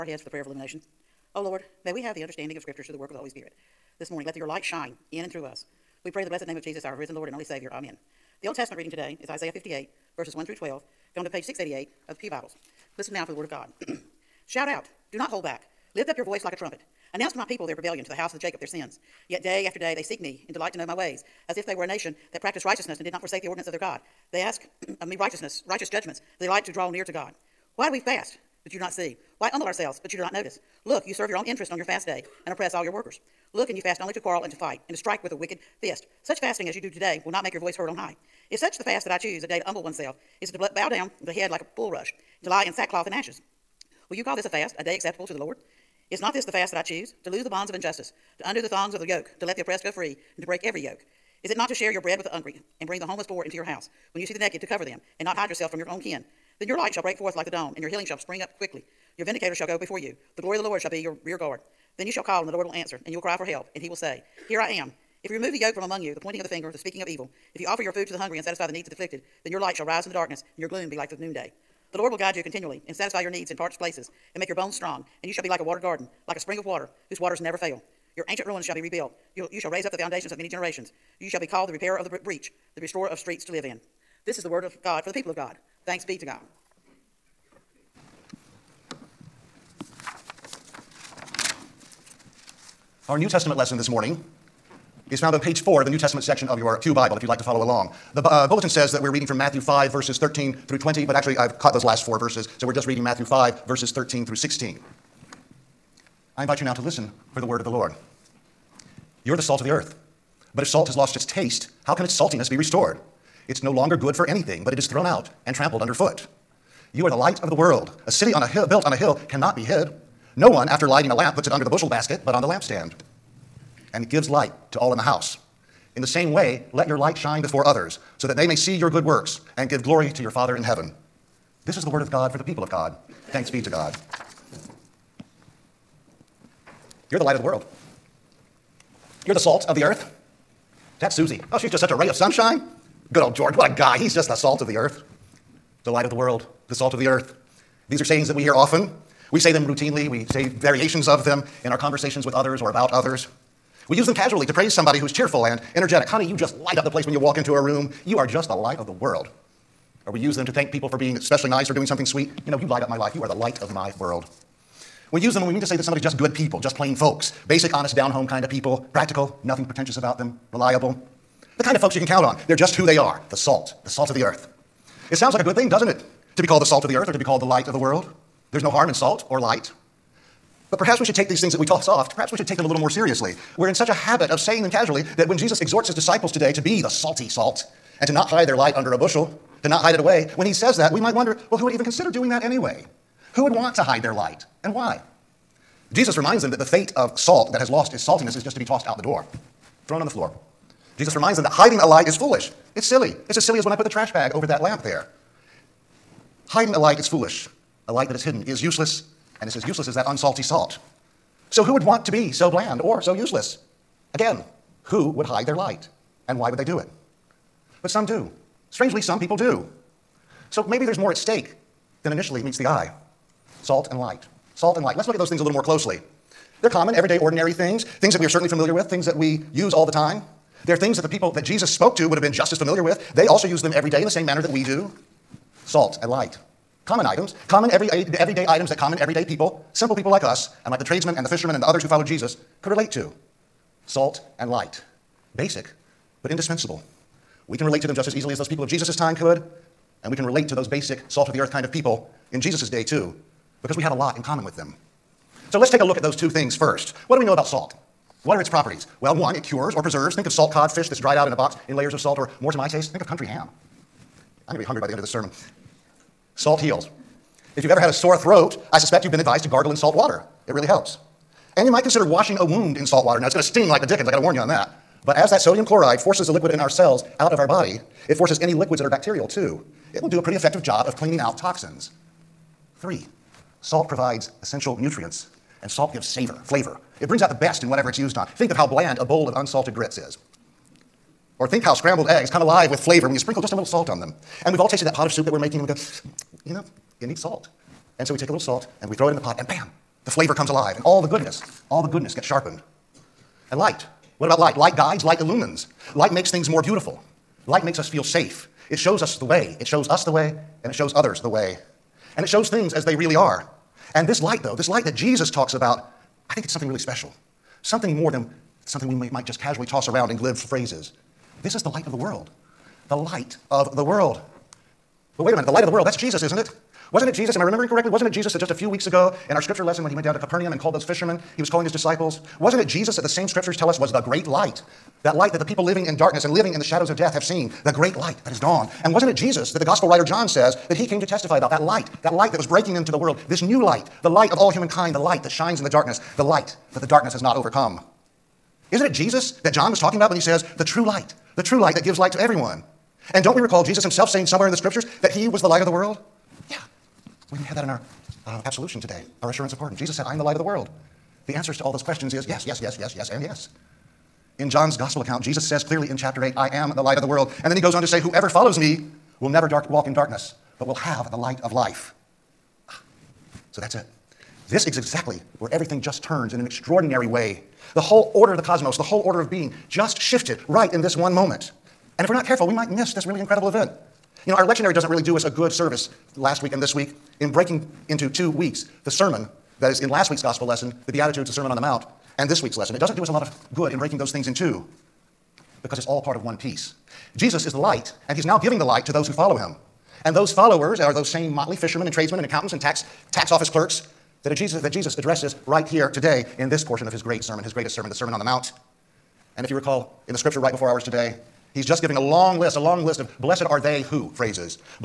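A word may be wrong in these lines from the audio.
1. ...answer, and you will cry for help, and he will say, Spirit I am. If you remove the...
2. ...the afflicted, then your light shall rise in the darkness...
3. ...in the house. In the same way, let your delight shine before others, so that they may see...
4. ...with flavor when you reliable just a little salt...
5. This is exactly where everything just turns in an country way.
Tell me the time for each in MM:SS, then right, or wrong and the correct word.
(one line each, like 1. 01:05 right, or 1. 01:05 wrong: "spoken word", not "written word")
1. 01:02 wrong: "Here", not "Spirit"
2. 01:08 right
3. 02:04 wrong: "light", not "delight"
4. 04:52 wrong: "sprinkle", not "reliable"
5. 06:14 wrong: "extraordinary", not "country".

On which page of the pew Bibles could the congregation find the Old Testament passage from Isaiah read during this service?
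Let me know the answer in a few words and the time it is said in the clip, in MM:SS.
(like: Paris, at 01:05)
688, at 00:11.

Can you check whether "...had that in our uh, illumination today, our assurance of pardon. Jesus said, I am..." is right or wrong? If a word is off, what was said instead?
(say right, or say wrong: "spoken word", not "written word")
wrong: "absolution", not "illumination".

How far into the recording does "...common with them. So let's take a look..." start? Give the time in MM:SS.
04:14.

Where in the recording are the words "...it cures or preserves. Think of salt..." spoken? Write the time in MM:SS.
04:19.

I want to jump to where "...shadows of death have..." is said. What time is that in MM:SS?
05:36.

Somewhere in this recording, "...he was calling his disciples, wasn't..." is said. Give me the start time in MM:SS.
05:31.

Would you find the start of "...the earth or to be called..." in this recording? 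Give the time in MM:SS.
02:56.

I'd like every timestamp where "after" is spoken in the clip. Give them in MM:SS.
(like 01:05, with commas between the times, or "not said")
00:19, 02:00.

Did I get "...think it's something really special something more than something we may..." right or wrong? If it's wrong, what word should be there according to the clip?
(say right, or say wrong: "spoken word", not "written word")
right.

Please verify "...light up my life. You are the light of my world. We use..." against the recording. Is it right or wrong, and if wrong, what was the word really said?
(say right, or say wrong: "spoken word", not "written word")
right.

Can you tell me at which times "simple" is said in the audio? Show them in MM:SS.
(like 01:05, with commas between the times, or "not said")
03:59.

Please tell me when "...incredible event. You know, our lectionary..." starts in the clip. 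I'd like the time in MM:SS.
06:23.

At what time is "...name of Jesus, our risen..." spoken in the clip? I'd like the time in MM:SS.
00:06.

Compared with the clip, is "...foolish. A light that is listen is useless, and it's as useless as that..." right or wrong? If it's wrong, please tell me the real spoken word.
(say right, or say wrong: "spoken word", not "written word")
wrong: "hidden", not "listen".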